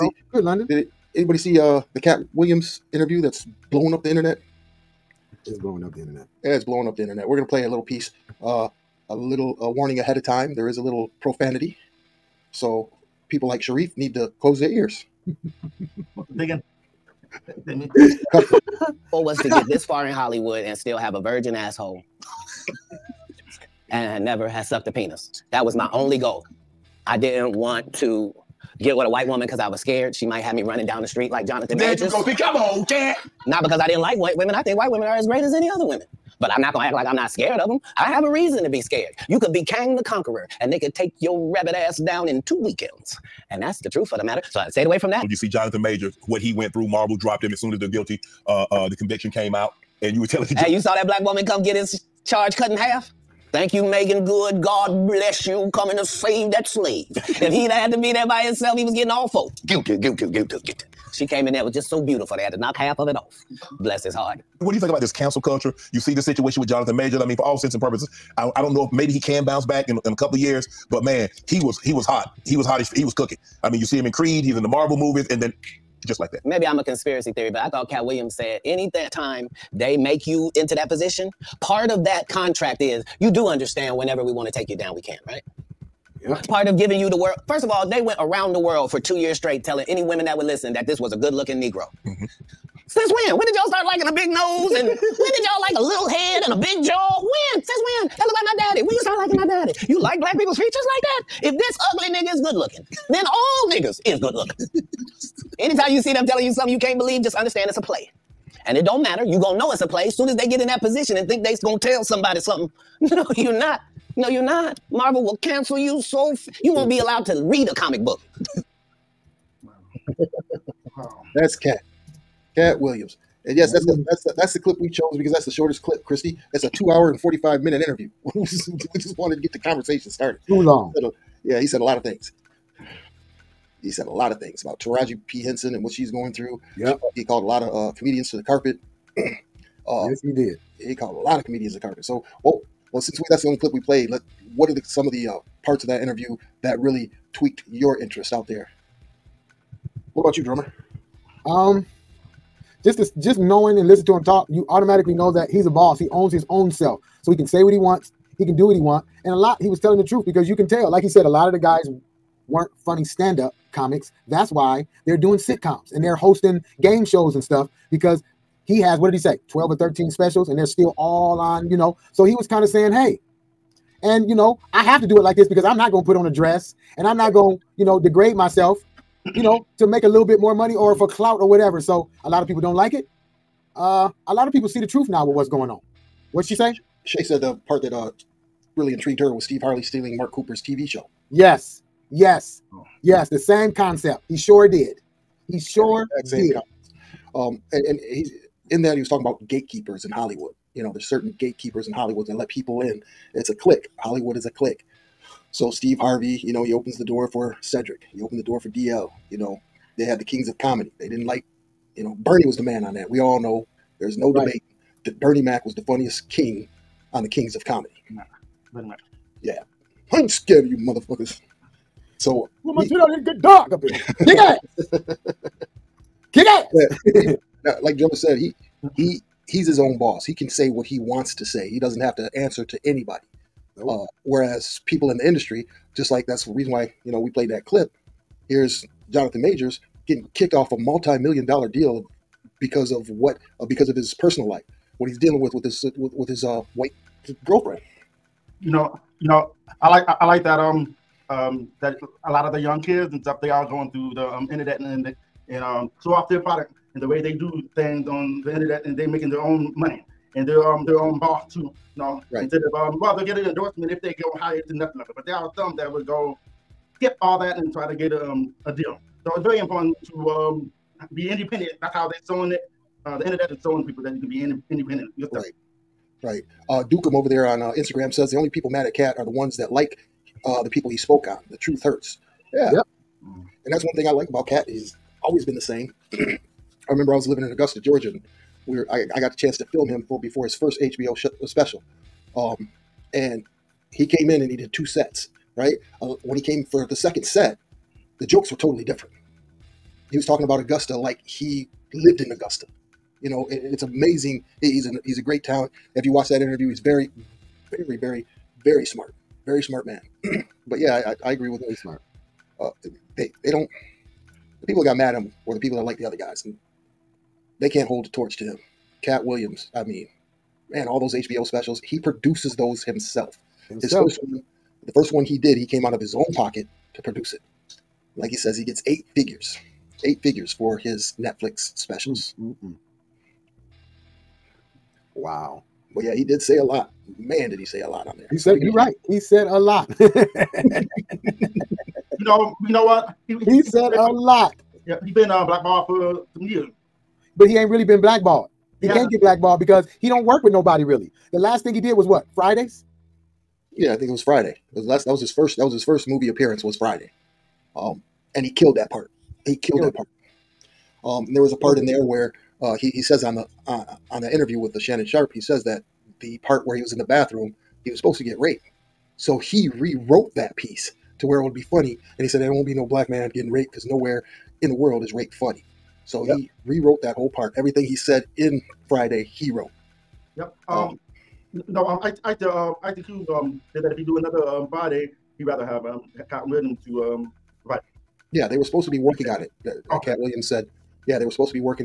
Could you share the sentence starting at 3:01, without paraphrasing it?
So a lot of people don't like it.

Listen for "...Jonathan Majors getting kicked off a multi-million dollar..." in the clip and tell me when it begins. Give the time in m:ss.
3:59.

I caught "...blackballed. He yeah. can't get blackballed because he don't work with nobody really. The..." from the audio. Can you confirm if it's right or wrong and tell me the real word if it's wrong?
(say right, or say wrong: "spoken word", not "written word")
right.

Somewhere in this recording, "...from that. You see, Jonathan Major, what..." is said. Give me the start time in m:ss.
0:44.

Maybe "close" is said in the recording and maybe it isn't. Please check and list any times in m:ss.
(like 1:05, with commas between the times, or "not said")
0:14.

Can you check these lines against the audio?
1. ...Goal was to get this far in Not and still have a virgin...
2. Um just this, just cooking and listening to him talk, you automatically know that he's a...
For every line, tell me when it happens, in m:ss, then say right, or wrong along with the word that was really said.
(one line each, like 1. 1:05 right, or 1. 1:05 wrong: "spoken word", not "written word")
1. 0:19 wrong: "Hollywood", not "Not"
2. 2:31 wrong: "knowing", not "cooking".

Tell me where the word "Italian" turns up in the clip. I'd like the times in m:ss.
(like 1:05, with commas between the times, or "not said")
not said.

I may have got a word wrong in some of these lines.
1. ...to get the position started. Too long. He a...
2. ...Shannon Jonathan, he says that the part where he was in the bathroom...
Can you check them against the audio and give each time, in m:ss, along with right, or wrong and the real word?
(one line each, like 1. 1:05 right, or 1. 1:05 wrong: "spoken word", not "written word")
1. 2:09 wrong: "conversation", not "position"
2. 6:04 wrong: "Sharpe", not "Jonathan".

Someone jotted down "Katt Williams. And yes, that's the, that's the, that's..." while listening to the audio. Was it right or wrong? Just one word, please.
right.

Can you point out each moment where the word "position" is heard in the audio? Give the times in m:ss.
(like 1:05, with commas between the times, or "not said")
1:20, 1:50.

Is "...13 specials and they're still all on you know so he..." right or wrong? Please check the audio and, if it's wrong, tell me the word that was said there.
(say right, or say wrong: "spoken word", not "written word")
right.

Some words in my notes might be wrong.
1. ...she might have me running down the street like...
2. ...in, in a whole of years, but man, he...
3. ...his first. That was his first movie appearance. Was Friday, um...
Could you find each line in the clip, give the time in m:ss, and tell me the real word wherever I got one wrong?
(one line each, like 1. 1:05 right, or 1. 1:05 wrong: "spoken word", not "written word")
1. 0:30 right
2. 1:09 wrong: "couple", not "whole"
3. 5:55 right.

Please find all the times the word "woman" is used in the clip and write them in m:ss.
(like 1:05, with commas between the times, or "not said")
0:29, 0:51.